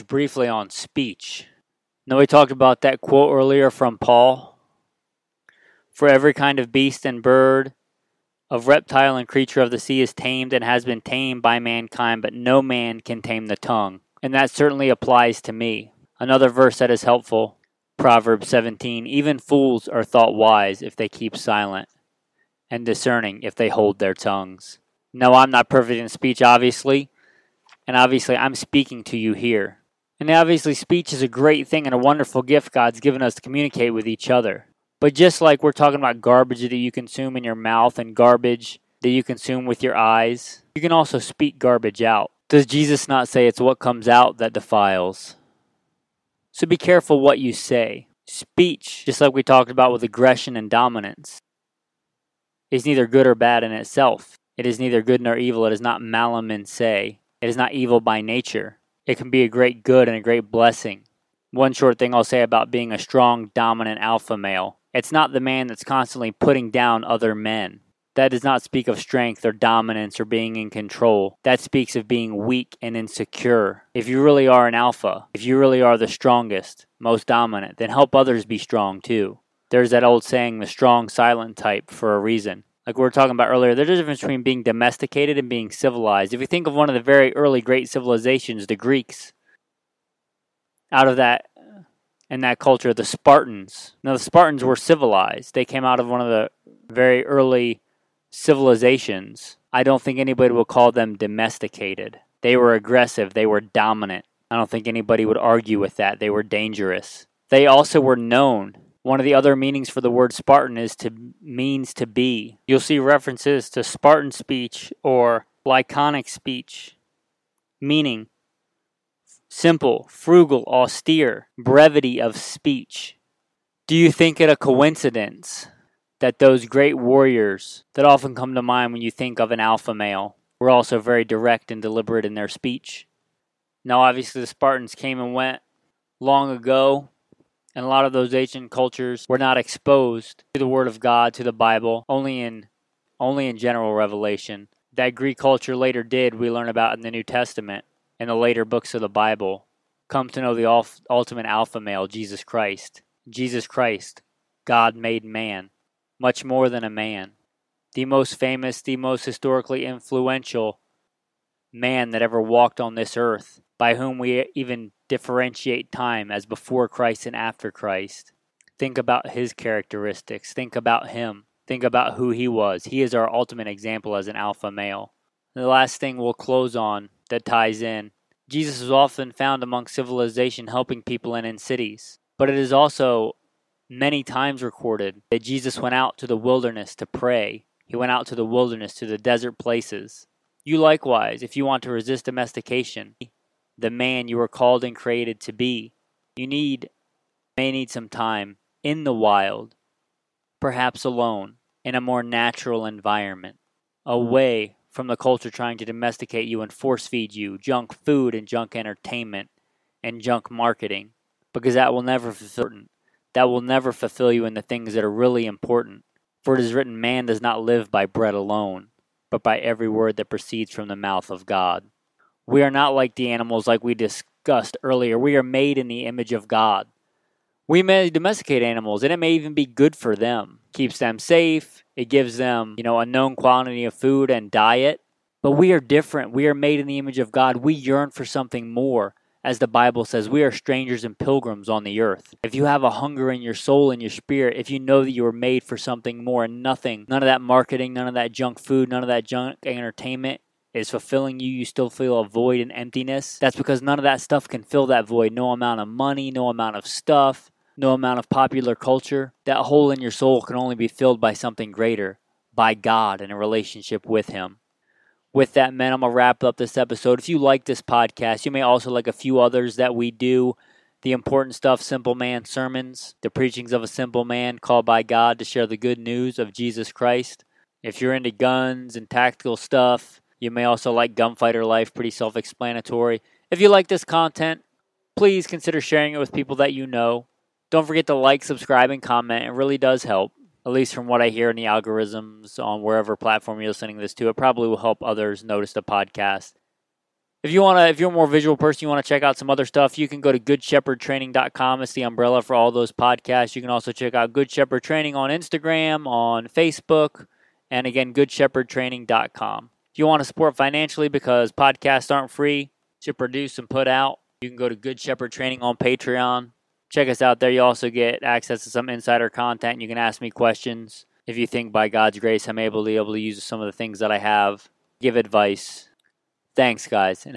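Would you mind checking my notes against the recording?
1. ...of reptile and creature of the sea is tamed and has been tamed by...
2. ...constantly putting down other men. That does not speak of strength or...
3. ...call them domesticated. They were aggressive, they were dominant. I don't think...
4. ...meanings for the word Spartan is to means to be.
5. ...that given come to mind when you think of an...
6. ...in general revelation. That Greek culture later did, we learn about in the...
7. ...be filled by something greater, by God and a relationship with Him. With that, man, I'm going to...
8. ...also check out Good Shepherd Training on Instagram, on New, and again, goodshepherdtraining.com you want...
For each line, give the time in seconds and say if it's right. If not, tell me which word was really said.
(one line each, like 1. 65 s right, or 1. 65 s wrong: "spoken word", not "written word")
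1. 8 s right
2. 65 s right
3. 100 s right
4. 109 s right
5. 127 s wrong: "often", not "given"
6. 143 s right
7. 260 s right
8. 303 s wrong: "Facebook", not "New".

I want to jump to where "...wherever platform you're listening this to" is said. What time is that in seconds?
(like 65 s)
292 s.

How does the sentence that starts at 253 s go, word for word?
That's because none of that stuff can fill that void.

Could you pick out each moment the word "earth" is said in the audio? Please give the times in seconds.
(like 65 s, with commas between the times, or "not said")
163 s, 241 s.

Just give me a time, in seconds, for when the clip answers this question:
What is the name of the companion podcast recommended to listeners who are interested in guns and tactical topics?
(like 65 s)
281 s.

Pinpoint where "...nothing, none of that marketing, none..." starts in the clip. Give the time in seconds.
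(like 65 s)
246 s.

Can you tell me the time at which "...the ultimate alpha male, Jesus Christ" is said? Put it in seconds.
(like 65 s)
150 s.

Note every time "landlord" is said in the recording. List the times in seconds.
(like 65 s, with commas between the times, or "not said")
not said.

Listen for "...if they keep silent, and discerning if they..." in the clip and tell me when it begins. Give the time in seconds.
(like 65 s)
20 s.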